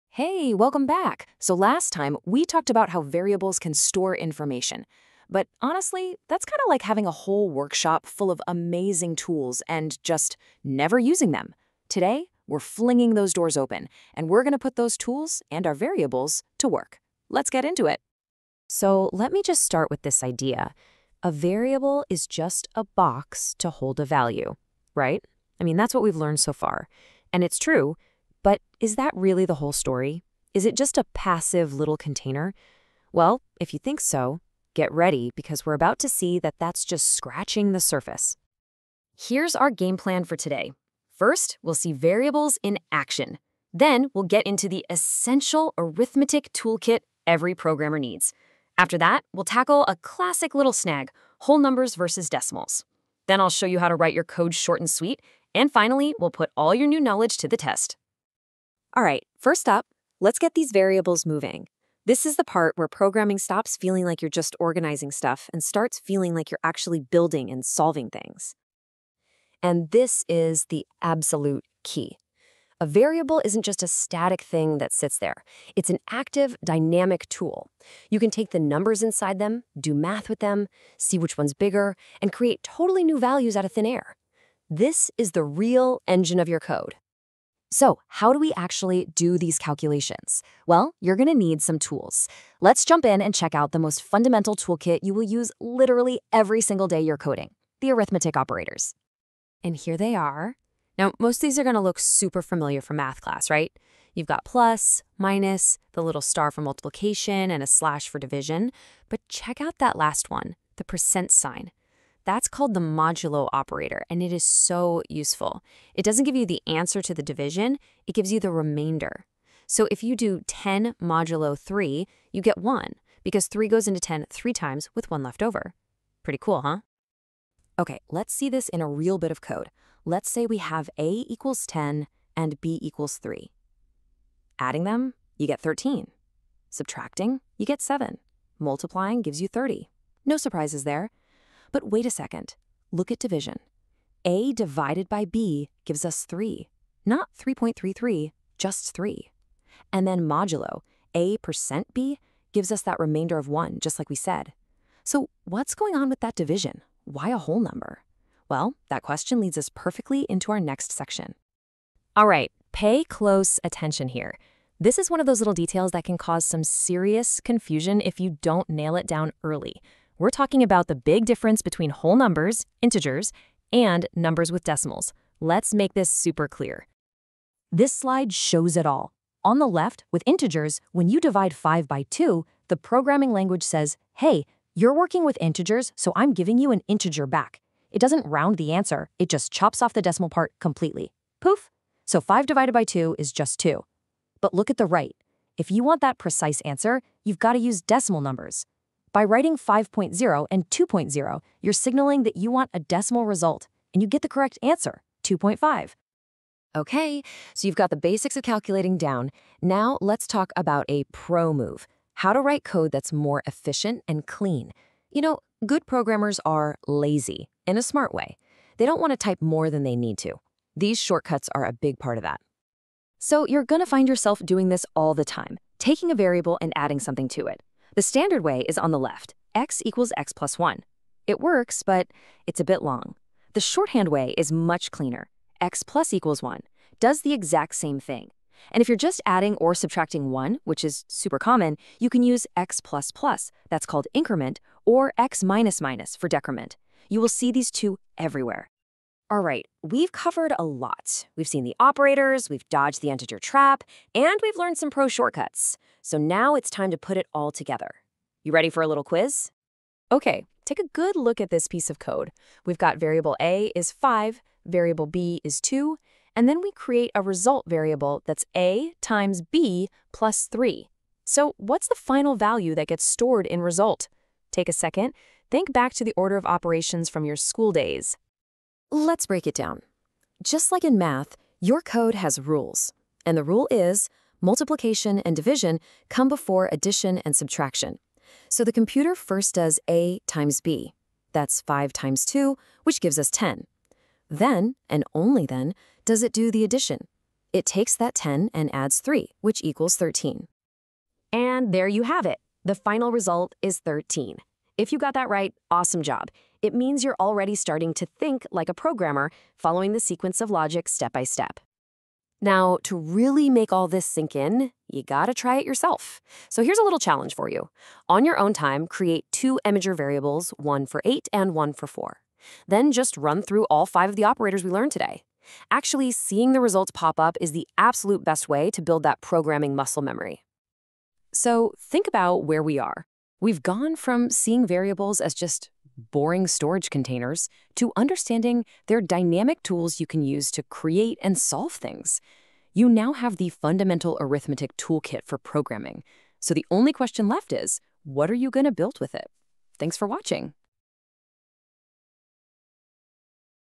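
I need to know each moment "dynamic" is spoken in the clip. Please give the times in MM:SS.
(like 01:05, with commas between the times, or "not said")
01:16, 05:39.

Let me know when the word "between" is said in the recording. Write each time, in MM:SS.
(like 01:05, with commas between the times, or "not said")
02:51.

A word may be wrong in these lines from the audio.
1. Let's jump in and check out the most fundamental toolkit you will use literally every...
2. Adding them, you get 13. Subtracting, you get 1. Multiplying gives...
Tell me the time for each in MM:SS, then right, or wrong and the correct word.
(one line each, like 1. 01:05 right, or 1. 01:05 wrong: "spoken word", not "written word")
1. 01:32 right
2. 02:14 wrong: "7", not "1".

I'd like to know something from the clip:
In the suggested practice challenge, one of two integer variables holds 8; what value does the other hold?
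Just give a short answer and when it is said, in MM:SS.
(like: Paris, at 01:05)
4, at 05:21.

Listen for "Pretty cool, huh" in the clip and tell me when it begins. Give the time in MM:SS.
02:06.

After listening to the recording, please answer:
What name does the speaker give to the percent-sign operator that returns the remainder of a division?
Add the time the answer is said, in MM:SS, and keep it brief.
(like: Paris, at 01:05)
modulo operator, at 01:52.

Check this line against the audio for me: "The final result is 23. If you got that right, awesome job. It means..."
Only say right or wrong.
wrong.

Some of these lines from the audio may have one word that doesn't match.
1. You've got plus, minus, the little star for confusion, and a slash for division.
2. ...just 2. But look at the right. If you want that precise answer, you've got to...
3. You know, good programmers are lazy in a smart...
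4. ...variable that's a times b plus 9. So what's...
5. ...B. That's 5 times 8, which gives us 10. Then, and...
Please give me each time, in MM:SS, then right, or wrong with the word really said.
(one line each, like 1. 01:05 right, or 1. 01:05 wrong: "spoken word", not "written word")
1. 01:44 wrong: "multiplication", not "confusion"
2. 03:13 right
3. 03:35 right
4. 04:27 wrong: "3", not "9"
5. 04:50 wrong: "2", not "8".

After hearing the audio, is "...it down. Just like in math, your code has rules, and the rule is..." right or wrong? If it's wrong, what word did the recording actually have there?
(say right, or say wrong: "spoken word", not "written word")
right.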